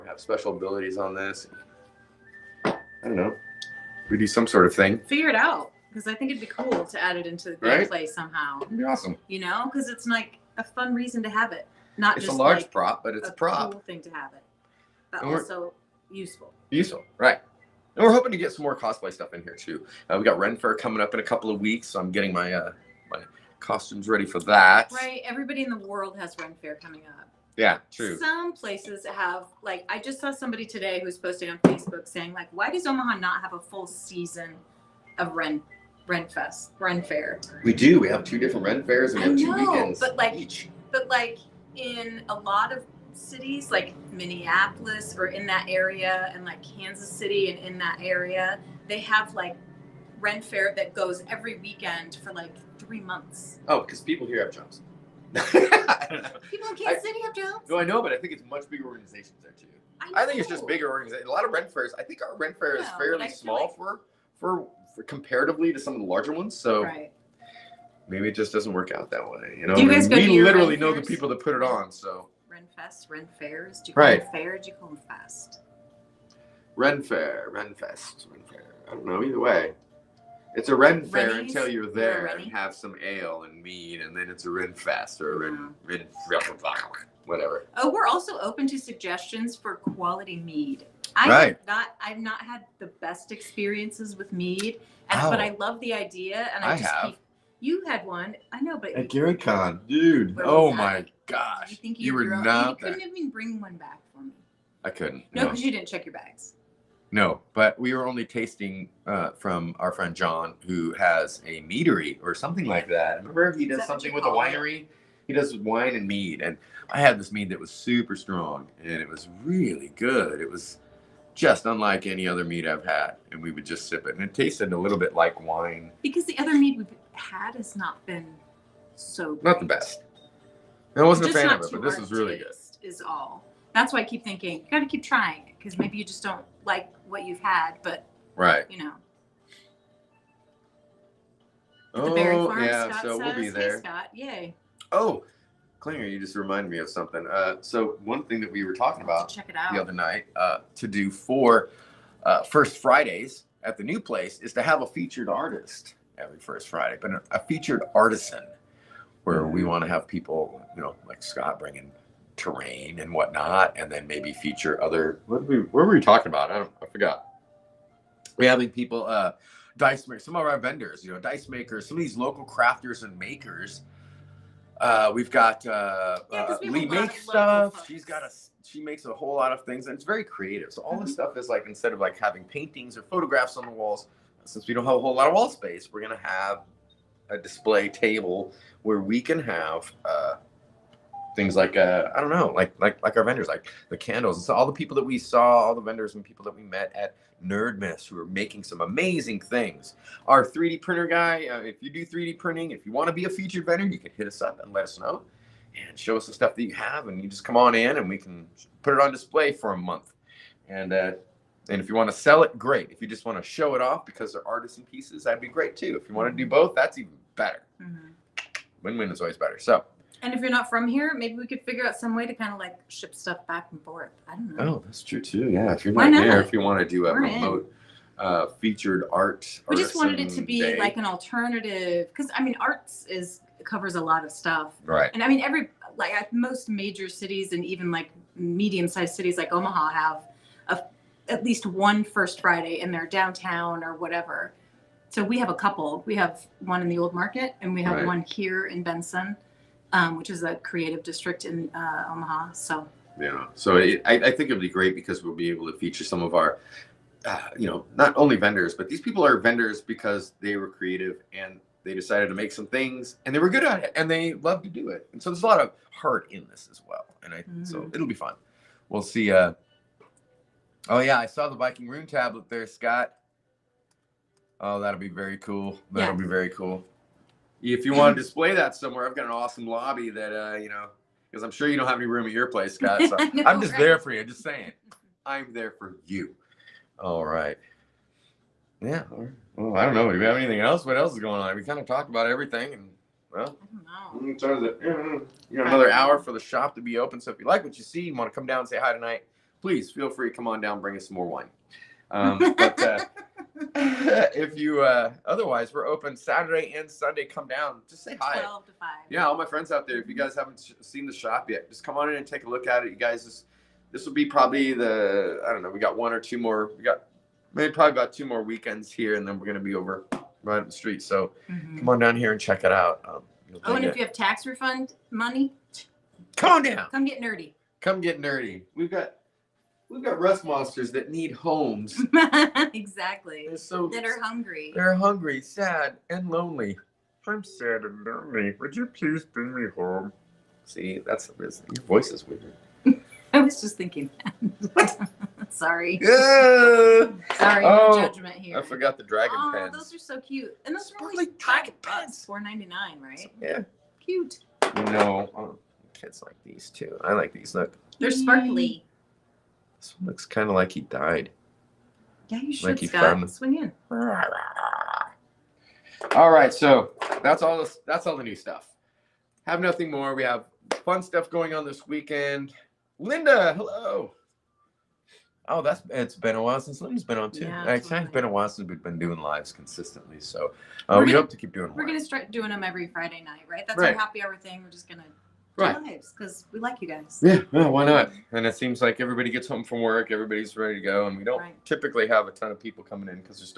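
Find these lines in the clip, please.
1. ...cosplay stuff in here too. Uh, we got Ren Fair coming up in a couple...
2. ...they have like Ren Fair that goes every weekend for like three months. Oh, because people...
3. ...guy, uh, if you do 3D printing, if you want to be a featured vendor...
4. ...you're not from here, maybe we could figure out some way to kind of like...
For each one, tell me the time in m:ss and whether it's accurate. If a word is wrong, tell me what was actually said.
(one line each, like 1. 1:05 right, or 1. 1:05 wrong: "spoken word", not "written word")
1. 0:18 right
2. 0:48 right
3. 3:21 right
4. 3:40 right.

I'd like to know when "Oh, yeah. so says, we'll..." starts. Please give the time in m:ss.
2:21.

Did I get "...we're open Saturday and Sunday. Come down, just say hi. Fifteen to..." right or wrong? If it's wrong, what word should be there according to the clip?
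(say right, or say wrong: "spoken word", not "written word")
wrong: "Twelve", not "Fifteen".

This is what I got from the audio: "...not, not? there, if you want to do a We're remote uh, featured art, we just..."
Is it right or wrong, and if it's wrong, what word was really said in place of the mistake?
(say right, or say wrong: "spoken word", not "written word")
right.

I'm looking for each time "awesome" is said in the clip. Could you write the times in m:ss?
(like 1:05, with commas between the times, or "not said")
0:08, 4:39.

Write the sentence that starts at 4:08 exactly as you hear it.
one here in Benson um, which is a creative district in uh, Omaha.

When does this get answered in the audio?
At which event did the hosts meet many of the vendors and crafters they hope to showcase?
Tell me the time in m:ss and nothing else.
3:17.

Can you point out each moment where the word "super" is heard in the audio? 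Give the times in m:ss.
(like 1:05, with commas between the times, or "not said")
1:57.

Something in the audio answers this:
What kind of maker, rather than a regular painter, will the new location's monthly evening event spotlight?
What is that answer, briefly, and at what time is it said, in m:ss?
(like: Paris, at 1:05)
featured artisan, at 2:37.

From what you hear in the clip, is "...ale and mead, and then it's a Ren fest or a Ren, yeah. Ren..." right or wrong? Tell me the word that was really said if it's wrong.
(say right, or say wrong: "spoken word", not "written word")
right.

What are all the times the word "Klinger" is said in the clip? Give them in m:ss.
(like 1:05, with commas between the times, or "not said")
2:25.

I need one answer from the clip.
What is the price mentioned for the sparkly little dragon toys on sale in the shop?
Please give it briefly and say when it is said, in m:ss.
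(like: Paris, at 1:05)
$4.99, at 5:52.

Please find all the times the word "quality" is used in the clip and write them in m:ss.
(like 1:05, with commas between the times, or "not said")
1:29.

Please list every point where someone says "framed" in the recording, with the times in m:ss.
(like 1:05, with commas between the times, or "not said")
not said.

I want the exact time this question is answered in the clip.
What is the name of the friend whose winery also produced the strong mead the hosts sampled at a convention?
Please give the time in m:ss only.
1:50.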